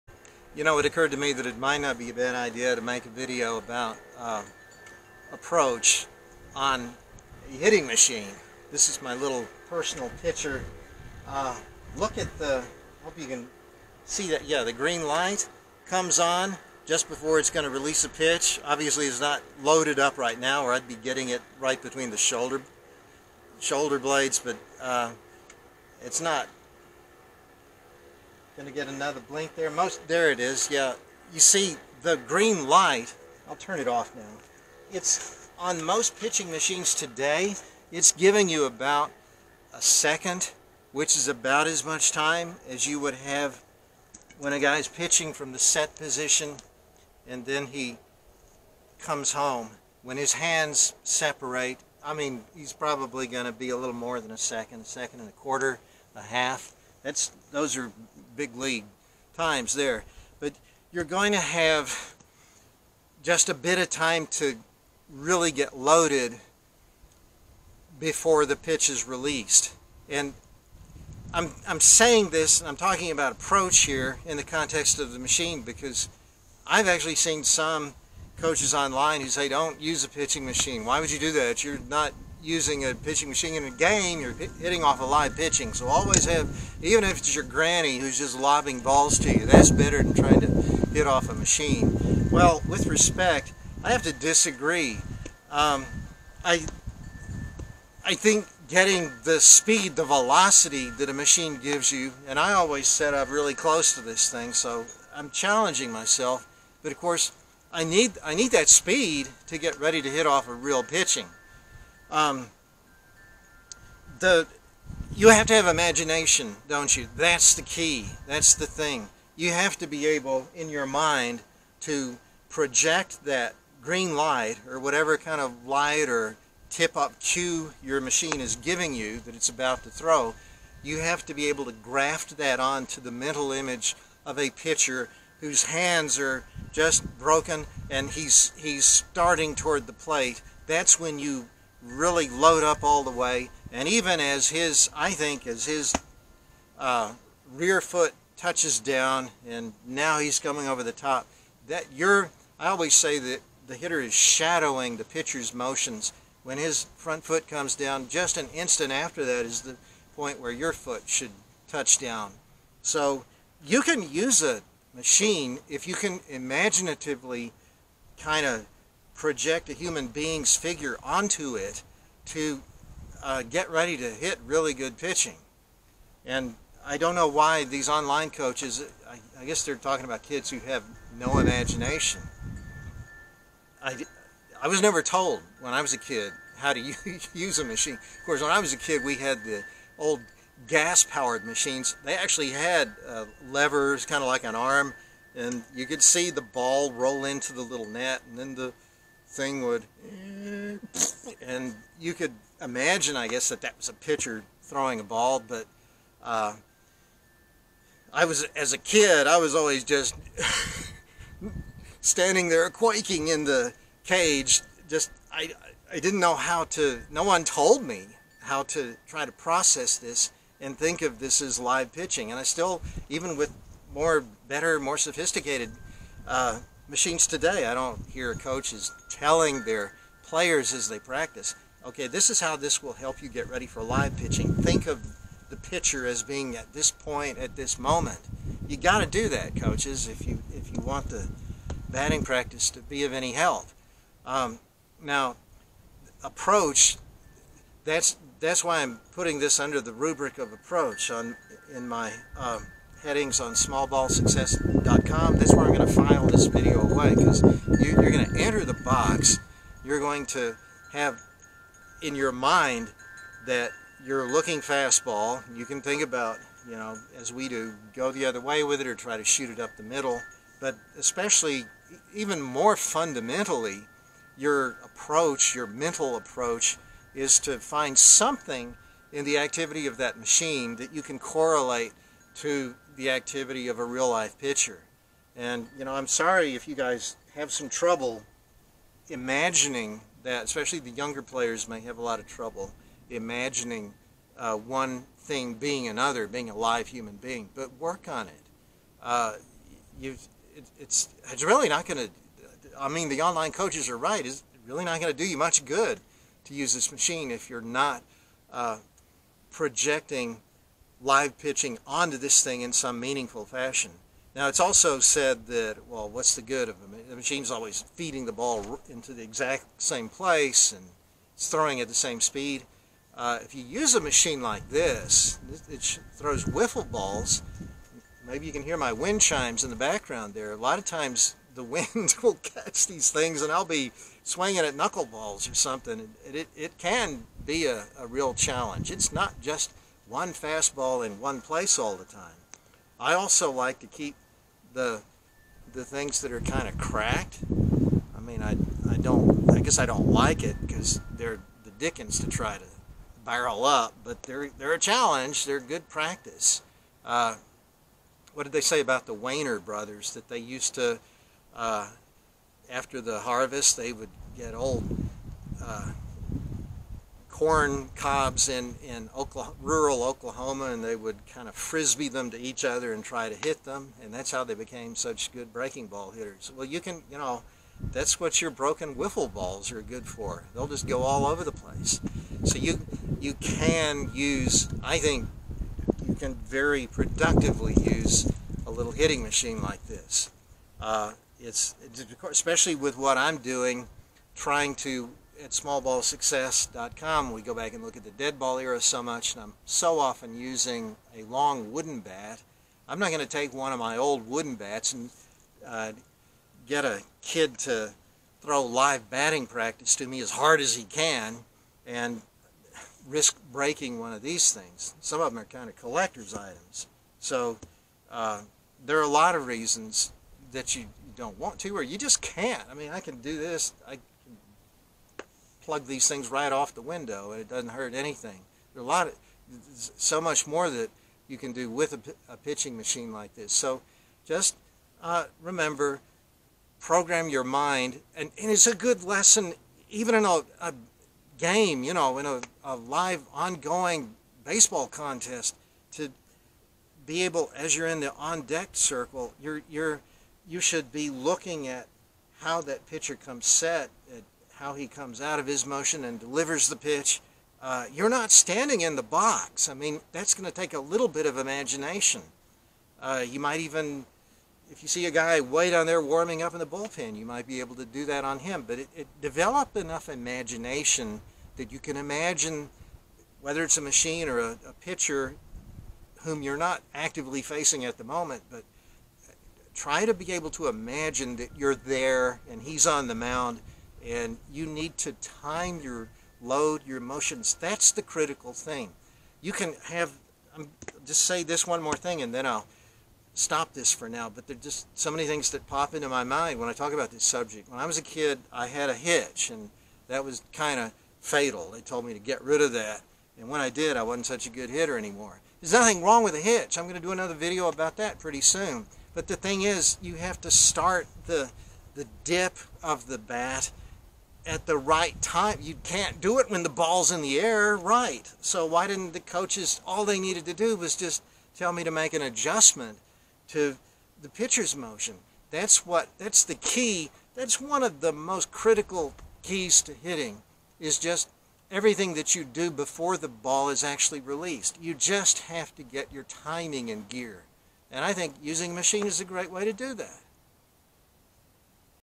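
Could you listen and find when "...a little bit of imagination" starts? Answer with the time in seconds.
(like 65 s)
460 s.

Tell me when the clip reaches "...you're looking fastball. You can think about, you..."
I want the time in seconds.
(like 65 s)
264 s.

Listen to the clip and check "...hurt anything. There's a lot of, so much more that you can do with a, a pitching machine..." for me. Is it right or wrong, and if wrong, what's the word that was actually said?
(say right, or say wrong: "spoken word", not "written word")
right.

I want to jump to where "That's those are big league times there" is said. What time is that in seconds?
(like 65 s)
57 s.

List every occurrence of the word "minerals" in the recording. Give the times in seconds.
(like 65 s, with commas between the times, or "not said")
not said.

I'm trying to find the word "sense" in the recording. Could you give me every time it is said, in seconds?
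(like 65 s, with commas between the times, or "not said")
not said.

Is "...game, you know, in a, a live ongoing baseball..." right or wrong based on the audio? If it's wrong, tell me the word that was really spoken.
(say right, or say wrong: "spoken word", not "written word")
right.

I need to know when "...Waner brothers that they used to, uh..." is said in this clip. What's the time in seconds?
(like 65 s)
359 s.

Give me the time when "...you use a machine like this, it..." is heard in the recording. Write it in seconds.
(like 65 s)
323 s.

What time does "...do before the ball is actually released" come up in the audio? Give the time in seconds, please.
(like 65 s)
532 s.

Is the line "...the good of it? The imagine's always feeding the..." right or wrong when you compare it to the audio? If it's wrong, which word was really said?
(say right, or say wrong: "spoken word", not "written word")
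wrong: "machine", not "imagine".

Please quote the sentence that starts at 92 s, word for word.
Well, with respect, I have to disagree.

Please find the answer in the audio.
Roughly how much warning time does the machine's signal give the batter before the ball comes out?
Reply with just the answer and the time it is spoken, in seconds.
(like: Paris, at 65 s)
about a second, at 38 s.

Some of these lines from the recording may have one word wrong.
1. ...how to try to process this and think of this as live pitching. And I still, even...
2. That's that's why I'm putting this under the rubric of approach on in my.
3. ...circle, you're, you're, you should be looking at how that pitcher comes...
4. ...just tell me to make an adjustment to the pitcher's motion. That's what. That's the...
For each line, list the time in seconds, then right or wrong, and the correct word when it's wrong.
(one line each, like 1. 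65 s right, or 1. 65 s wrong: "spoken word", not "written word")
1. 218 s right
2. 247 s right
3. 448 s right
4. 520 s right.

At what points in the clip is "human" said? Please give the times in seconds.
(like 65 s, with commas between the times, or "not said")
169 s, 296 s.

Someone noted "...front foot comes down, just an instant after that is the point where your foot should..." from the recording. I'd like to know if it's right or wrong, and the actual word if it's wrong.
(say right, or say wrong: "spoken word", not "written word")
right.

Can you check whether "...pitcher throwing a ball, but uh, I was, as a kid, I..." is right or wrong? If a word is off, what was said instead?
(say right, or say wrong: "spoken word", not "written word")
right.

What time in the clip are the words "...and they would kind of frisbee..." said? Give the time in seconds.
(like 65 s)
370 s.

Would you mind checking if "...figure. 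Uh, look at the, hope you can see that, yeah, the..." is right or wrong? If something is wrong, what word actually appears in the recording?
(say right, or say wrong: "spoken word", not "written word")
wrong: "picture", not "figure".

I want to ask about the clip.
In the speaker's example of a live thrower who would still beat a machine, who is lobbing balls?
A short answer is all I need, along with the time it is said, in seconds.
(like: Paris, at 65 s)
granny, at 87 s.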